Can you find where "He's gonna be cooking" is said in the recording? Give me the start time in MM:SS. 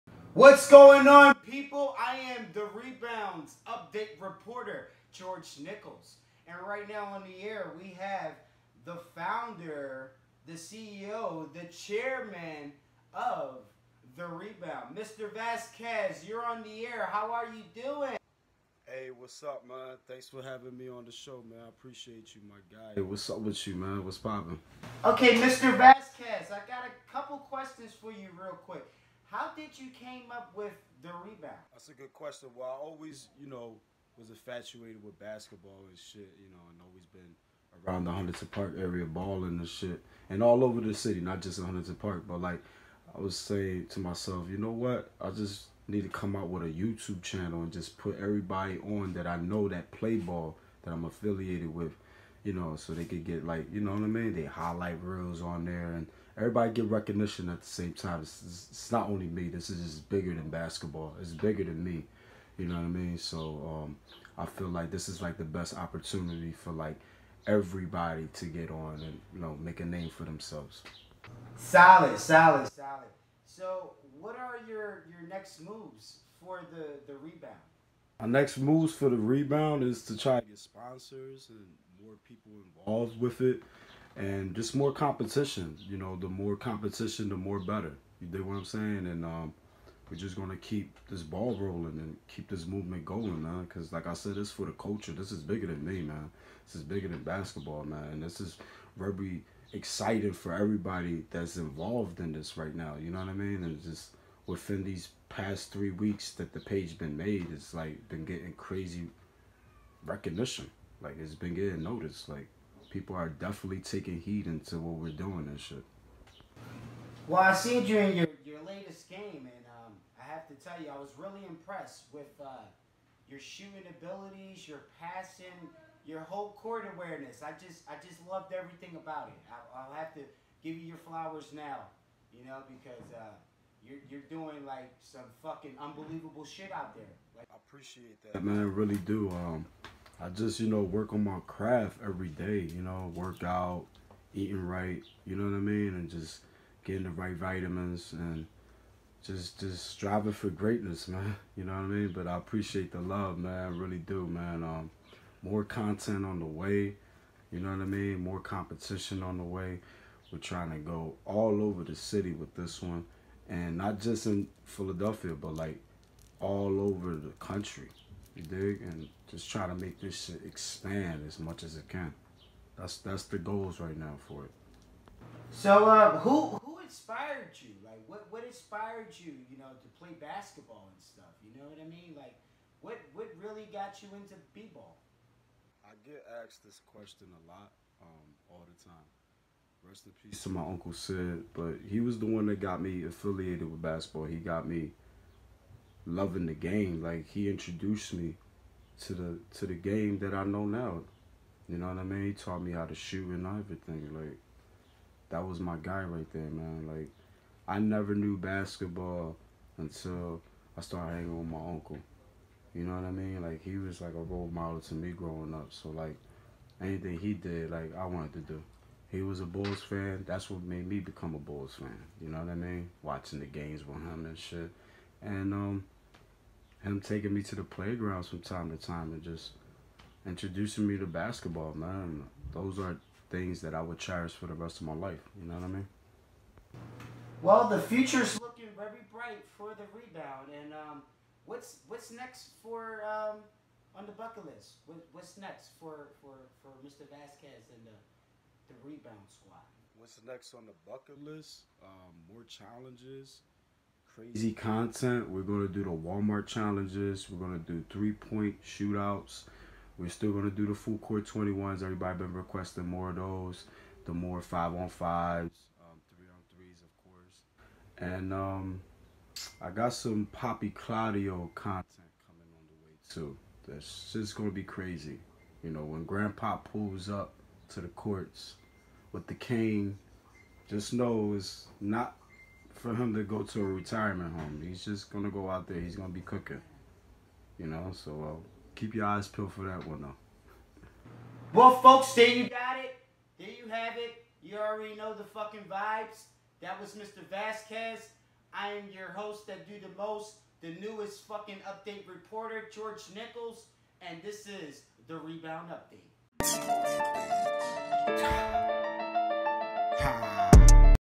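04:45.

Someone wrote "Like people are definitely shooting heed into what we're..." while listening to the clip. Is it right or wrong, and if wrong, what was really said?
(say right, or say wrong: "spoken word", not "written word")
wrong: "taking", not "shooting".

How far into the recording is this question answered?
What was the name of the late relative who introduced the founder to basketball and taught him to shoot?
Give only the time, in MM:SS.
03:10.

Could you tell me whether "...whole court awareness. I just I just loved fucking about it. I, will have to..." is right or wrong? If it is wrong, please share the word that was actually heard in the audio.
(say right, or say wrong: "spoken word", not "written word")
wrong: "everything", not "fucking".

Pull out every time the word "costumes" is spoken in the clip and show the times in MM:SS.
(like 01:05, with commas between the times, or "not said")
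not said.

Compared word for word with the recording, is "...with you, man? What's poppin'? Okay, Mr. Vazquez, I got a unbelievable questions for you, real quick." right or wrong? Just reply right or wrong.
wrong.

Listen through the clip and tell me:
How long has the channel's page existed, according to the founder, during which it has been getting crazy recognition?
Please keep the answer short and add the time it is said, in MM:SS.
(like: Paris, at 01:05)
3 weeks, at 01:45.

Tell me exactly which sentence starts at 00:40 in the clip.
And all over the city, not just in Huntington Park, but like I was saying to myself, you know what?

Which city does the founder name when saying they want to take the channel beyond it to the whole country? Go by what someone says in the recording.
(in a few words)
Philadelphia.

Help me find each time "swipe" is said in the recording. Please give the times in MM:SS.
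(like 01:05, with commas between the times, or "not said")
not said.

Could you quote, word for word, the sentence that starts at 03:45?
And um, him taking me to the playgrounds from time to time and just introducing me to basketball, man.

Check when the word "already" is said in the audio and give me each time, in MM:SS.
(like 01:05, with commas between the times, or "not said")
04:54.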